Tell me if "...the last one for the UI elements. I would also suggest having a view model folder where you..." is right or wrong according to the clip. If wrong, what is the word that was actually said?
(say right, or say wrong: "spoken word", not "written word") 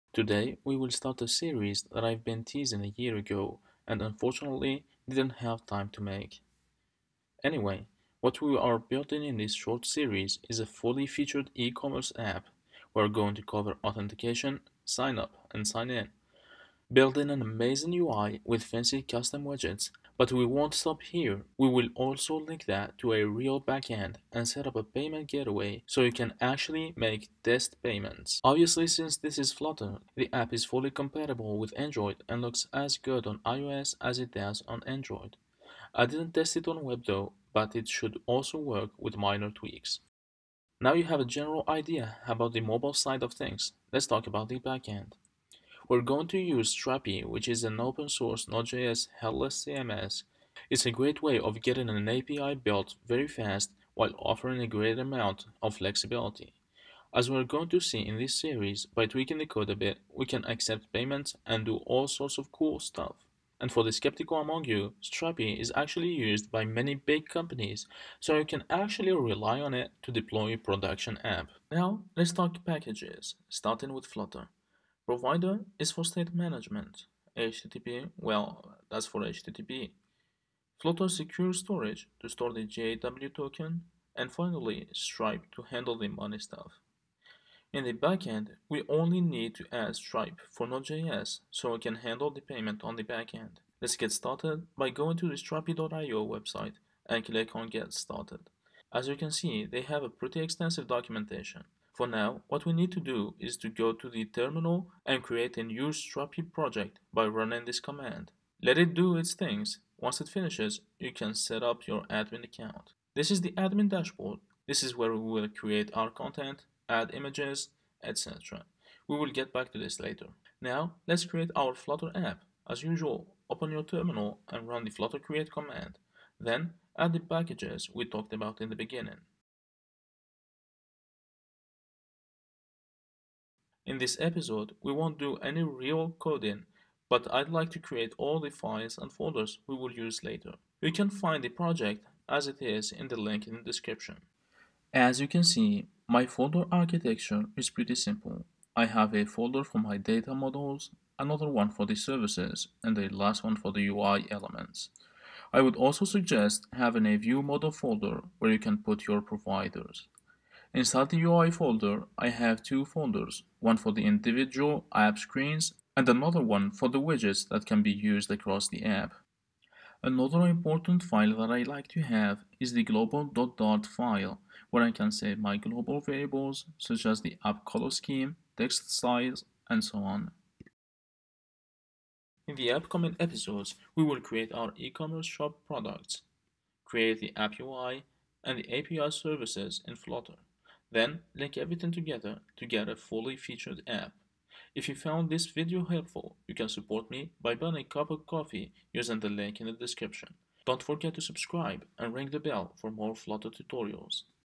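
right.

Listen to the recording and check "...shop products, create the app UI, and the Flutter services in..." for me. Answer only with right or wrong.
wrong.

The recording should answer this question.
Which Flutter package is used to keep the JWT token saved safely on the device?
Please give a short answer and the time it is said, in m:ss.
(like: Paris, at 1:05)
Flutter secure storage, at 1:20.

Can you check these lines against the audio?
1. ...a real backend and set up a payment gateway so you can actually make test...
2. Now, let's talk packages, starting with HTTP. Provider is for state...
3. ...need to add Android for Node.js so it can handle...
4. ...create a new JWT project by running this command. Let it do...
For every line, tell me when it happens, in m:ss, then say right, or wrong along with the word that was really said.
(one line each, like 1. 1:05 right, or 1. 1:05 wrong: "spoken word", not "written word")
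1. 0:23 right
2. 1:11 wrong: "Flutter", not "HTTP"
3. 1:29 wrong: "Stripe", not "Android"
4. 1:45 wrong: "Strapi", not "JWT".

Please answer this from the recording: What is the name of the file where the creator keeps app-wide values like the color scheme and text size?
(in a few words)
global.dart.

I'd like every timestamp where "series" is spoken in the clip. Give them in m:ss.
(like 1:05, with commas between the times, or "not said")
0:01, 0:09, 0:58.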